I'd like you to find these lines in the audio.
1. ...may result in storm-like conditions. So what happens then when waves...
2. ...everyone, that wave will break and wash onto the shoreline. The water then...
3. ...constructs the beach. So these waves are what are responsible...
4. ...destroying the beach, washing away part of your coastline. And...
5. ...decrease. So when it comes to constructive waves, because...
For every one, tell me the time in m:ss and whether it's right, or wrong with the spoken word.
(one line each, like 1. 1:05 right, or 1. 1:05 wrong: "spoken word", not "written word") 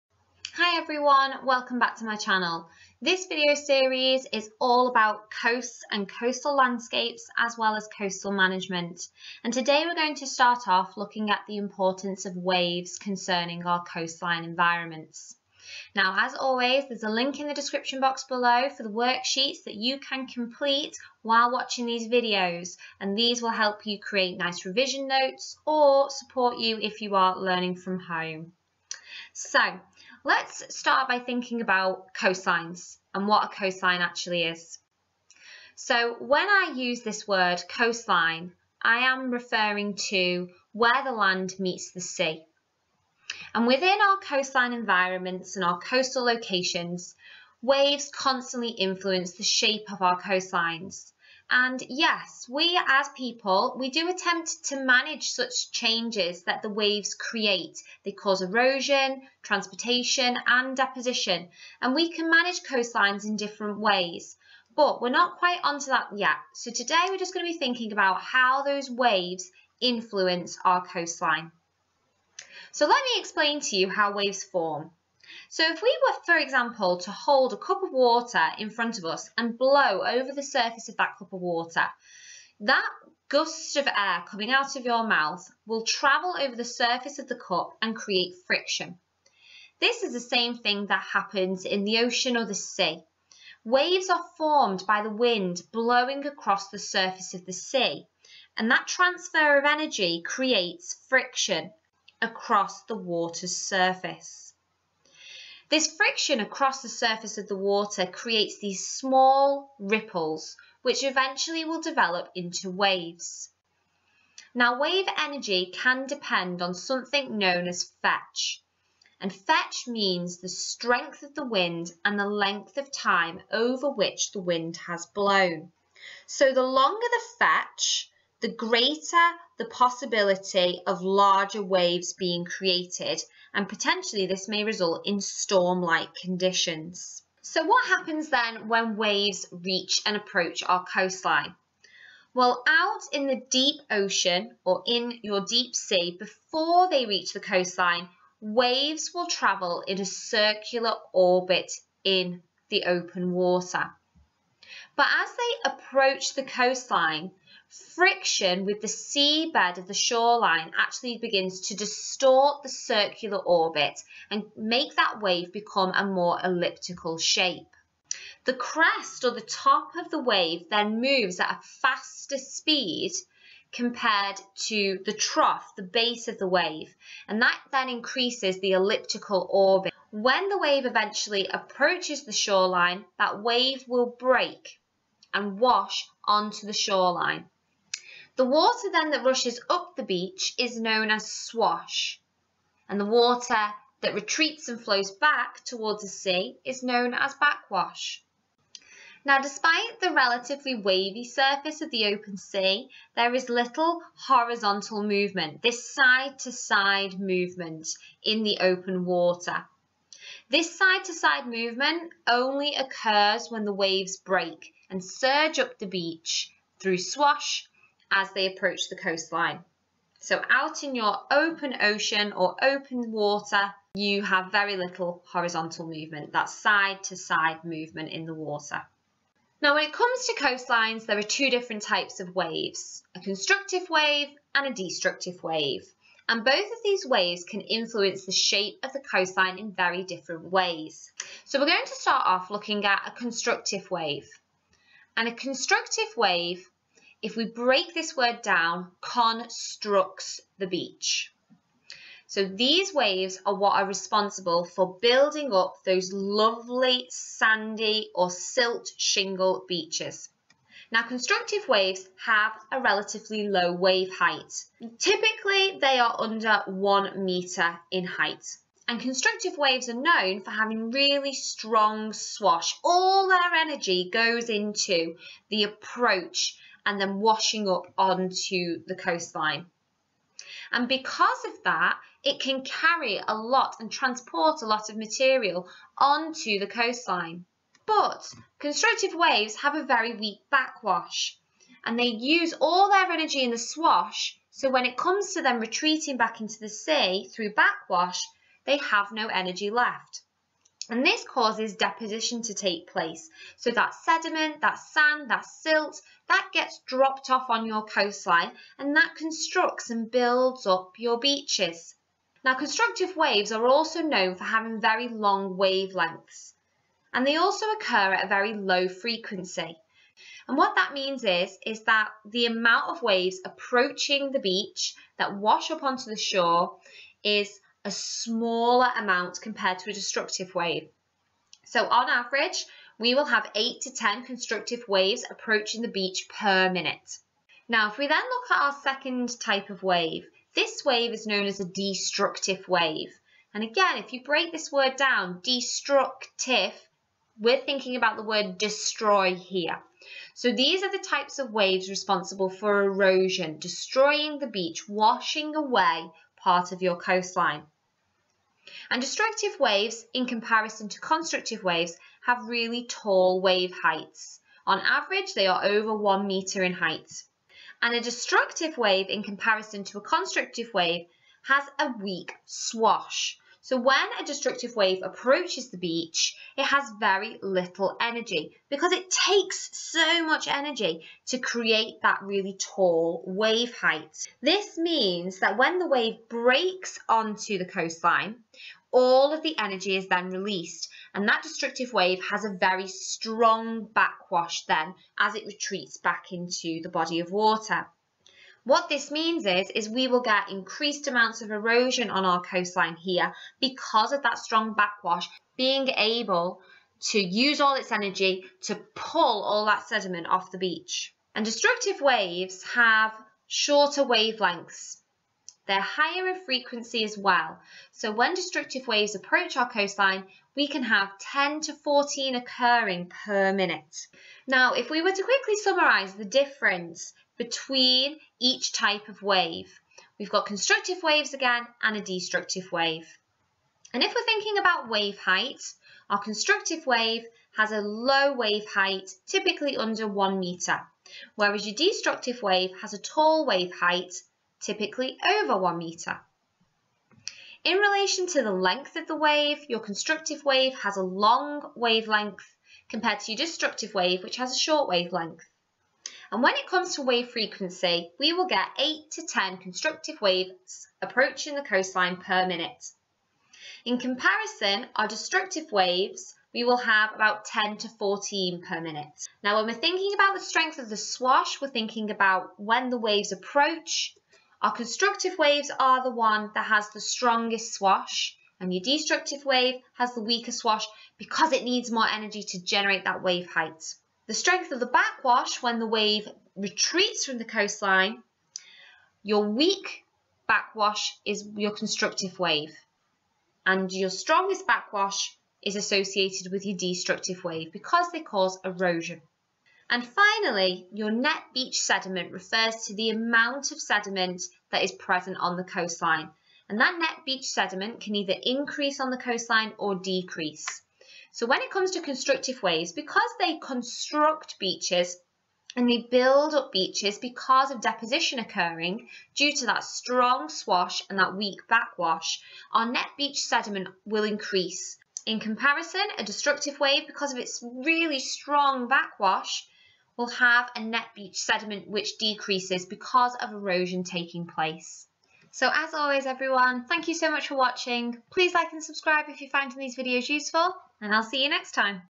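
1. 2:14 right
2. 3:02 wrong: "shoreline", not "everyone"
3. 4:08 right
4. 5:53 right
5. 8:29 right.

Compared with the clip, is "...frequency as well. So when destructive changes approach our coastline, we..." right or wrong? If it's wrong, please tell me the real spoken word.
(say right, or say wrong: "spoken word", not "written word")
wrong: "waves", not "changes".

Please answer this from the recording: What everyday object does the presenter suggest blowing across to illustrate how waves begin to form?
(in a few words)
A cup of water.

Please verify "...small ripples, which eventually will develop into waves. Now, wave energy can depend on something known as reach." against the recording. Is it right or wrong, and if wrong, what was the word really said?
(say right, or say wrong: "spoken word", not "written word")
wrong: "fetch", not "reach".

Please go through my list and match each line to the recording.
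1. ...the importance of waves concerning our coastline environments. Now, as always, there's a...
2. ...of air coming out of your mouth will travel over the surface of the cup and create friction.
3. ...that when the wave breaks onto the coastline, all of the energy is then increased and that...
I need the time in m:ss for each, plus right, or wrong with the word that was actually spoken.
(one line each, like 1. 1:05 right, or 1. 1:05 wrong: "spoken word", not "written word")
1. 0:11 right
2. 1:23 right
3. 6:25 wrong: "released", not "increased".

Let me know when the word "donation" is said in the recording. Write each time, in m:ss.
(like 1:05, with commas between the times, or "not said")
not said.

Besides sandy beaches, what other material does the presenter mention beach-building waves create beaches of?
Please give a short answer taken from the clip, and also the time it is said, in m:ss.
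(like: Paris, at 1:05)
Silt shingle, at 4:18.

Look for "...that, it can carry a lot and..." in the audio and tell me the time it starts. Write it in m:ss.
4:41.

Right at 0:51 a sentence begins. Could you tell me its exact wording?
And yes, we as people, we do attempt to manage such changes that the waves create.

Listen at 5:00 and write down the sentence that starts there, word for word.
And this causes deposition to take place.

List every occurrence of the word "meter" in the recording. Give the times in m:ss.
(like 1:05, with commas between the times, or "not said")
7:20, 7:25.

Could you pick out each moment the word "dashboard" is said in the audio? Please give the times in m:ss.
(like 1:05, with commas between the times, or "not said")
not said.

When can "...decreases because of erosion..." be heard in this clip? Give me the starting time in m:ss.
8:52.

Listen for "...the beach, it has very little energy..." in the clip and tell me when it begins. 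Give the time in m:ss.
6:15.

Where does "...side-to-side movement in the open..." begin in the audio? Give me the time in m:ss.
3:25.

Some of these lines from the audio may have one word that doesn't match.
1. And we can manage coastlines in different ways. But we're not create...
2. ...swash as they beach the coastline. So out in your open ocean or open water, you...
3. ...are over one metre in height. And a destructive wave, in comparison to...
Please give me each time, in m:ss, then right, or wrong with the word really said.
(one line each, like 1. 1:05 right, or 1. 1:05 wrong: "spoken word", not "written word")
1. 1:01 wrong: "quite", not "create"
2. 3:36 wrong: "approach", not "beach"
3. 6:05 right.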